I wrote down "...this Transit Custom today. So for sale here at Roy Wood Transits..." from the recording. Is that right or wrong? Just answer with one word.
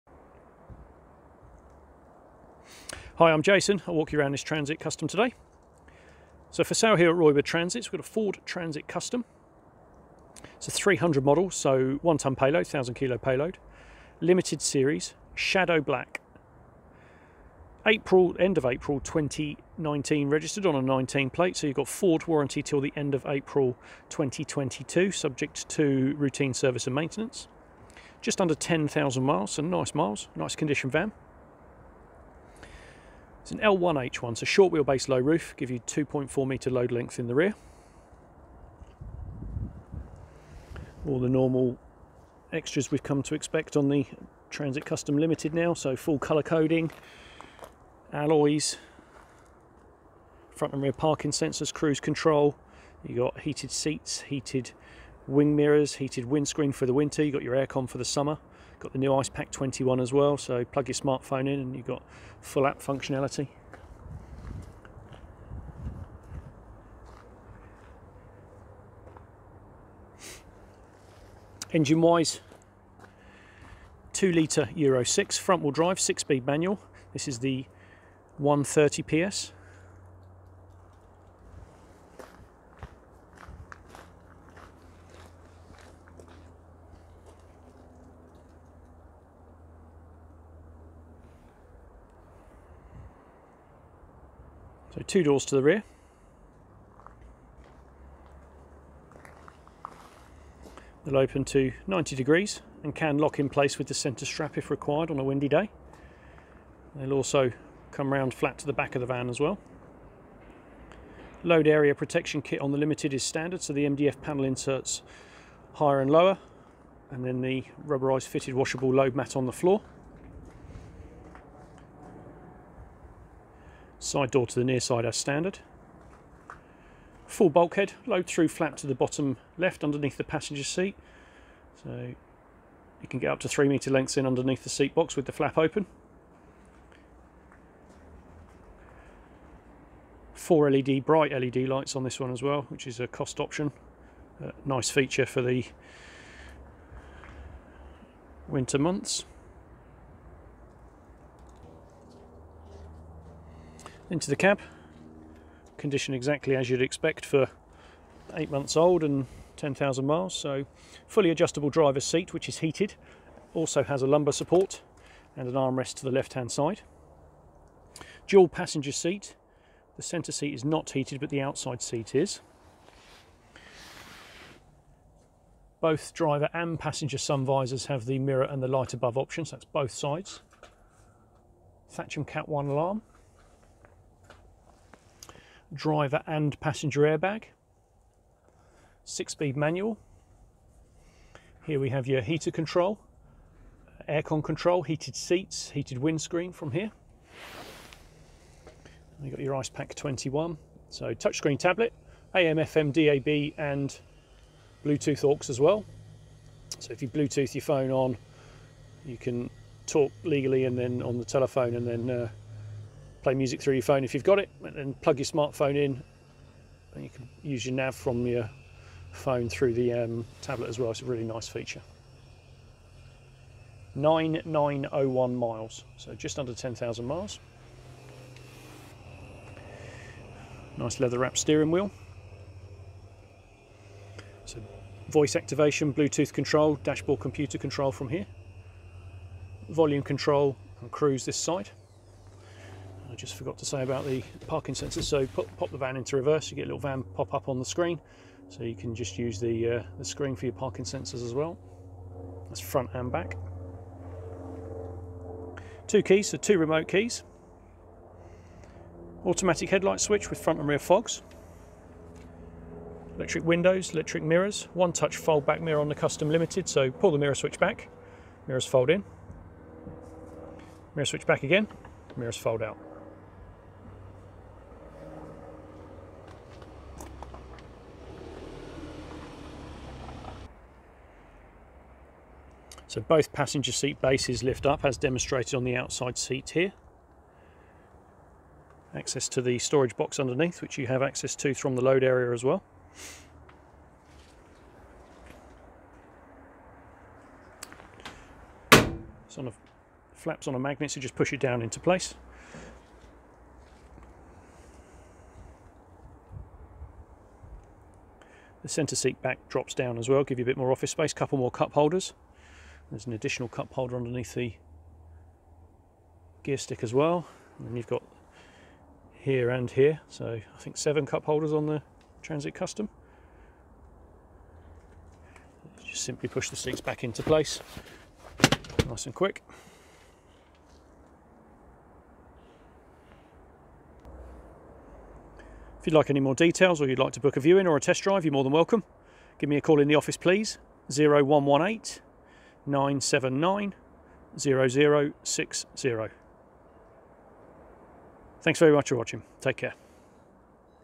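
right.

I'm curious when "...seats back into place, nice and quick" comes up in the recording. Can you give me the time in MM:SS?
05:26.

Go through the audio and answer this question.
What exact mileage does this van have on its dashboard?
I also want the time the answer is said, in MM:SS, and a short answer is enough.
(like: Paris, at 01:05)
9901 miles, at 03:43.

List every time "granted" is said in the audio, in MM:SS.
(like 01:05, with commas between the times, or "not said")
not said.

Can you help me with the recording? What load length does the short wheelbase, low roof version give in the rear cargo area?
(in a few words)
2.4 metre.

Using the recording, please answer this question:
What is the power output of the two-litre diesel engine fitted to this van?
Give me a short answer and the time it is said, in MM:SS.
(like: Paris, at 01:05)
130 PS, at 01:18.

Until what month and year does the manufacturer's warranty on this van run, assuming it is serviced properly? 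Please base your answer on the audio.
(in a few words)
April 2022.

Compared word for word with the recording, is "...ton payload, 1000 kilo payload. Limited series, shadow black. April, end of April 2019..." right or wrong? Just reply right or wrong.
right.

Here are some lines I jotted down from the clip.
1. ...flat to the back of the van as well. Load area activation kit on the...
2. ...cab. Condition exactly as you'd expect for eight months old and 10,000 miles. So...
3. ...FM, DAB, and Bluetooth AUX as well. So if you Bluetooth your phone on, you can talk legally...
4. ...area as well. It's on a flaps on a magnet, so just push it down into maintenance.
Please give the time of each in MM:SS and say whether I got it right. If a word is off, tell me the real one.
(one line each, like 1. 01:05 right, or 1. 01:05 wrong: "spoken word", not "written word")
1. 01:48 wrong: "protection", not "activation"
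2. 02:34 right
3. 03:22 right
4. 04:52 wrong: "place", not "maintenance".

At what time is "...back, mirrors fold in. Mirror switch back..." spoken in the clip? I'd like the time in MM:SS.
04:27.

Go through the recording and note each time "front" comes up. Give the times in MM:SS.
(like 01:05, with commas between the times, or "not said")
00:50, 01:15, 04:12, 04:20.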